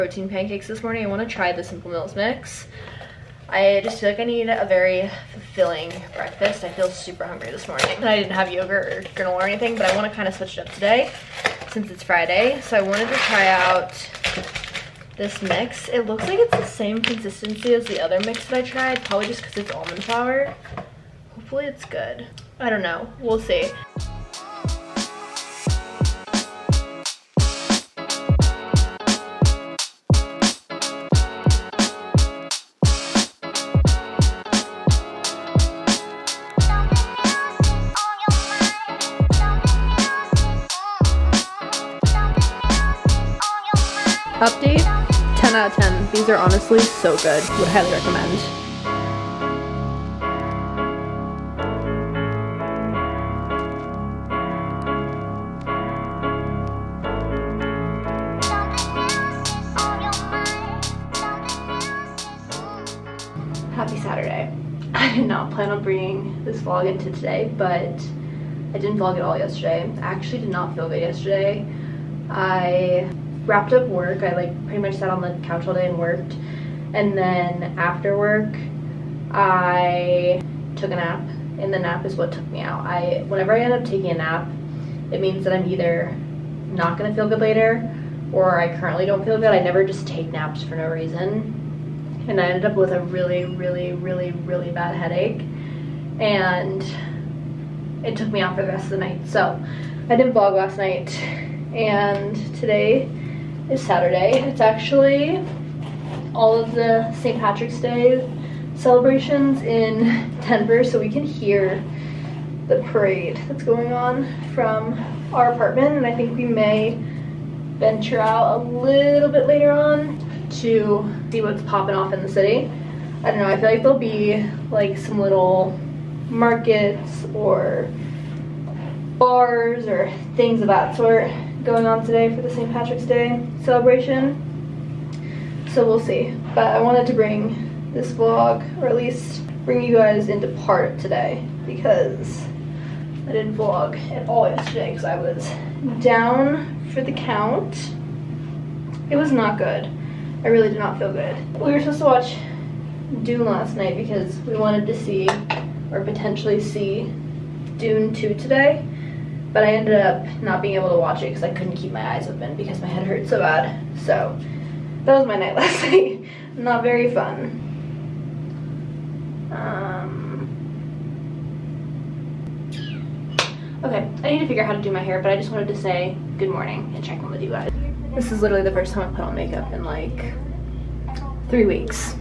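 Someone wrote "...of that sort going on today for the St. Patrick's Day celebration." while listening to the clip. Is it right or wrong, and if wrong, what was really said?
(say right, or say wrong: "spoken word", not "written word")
right.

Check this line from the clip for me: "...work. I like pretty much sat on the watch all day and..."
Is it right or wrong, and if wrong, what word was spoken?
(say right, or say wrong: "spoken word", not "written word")
wrong: "couch", not "watch".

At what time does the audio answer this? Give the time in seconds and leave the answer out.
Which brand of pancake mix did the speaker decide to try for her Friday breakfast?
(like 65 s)
1 s.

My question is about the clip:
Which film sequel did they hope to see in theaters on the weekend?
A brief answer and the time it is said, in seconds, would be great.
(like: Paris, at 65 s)
Dune 2, at 157 s.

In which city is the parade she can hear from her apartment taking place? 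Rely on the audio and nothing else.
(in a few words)
Denver.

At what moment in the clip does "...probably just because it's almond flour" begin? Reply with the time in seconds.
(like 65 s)
19 s.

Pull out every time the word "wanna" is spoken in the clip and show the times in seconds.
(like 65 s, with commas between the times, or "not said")
1 s, 9 s.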